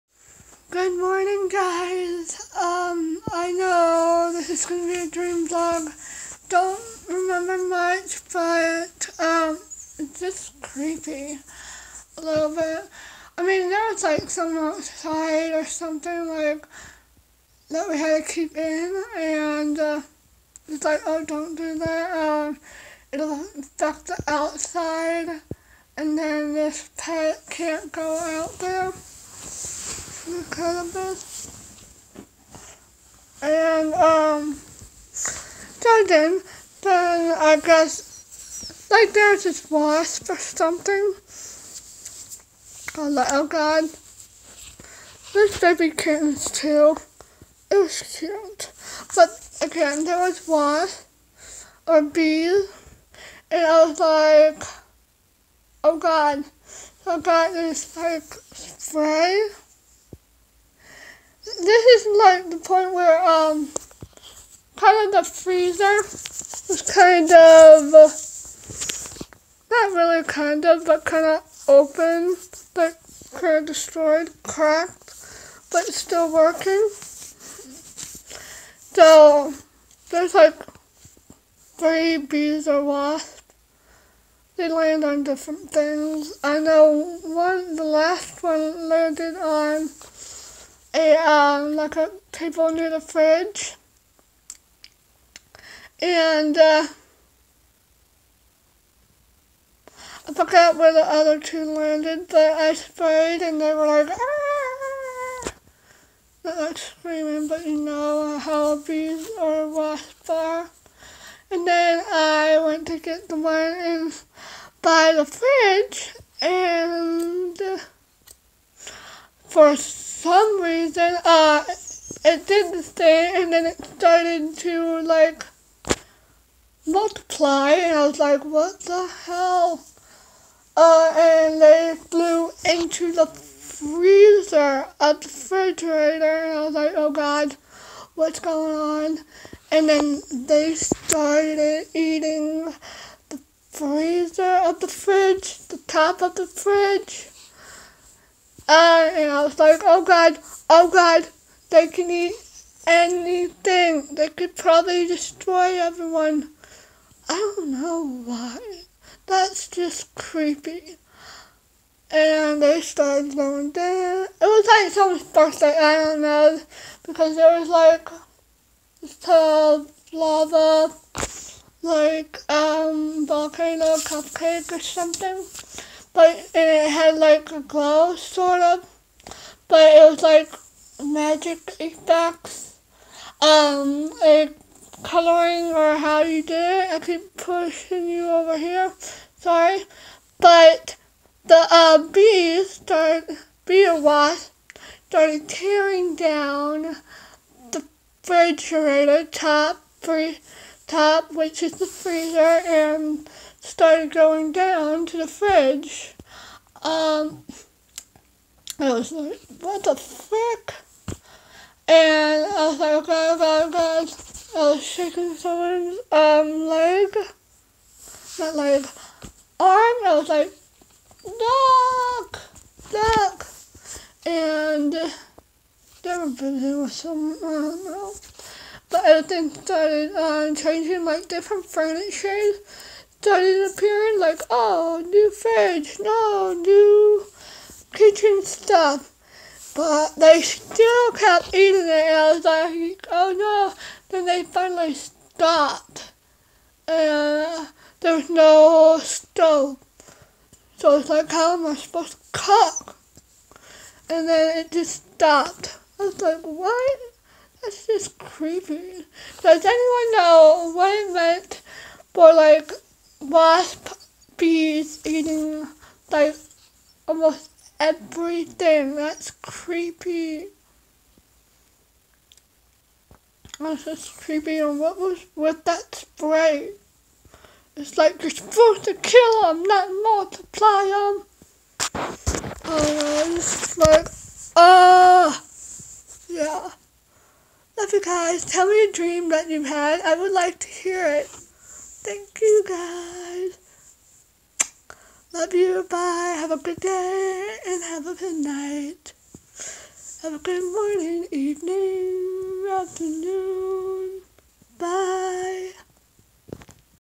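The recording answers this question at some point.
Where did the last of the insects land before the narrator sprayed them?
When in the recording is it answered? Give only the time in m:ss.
1:31.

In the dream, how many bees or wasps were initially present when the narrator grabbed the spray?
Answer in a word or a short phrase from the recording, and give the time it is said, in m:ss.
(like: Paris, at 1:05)
3, at 1:21.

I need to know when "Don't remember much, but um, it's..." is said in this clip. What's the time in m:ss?
0:06.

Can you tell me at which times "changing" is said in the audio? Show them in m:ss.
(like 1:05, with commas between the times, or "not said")
3:50.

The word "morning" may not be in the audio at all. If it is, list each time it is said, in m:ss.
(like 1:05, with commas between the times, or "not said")
0:00, 5:00.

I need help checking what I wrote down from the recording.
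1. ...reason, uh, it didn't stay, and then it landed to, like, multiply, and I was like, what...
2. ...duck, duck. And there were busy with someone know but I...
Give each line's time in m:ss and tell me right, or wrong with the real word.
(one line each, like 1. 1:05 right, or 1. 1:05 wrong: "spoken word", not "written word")
1. 2:00 wrong: "started", not "landed"
2. 3:42 right.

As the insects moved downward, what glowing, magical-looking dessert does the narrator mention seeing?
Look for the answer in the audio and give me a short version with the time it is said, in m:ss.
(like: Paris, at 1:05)
volcano cupcake, at 2:53.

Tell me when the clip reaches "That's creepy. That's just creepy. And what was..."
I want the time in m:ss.
4:28.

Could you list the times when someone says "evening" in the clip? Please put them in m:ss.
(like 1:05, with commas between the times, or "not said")
5:01.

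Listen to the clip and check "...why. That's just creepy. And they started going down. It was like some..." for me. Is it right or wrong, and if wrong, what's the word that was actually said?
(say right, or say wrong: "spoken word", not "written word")
right.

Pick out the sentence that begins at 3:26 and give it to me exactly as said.
Um, I was like, what the frick?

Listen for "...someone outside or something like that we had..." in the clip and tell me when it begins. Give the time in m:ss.
0:14.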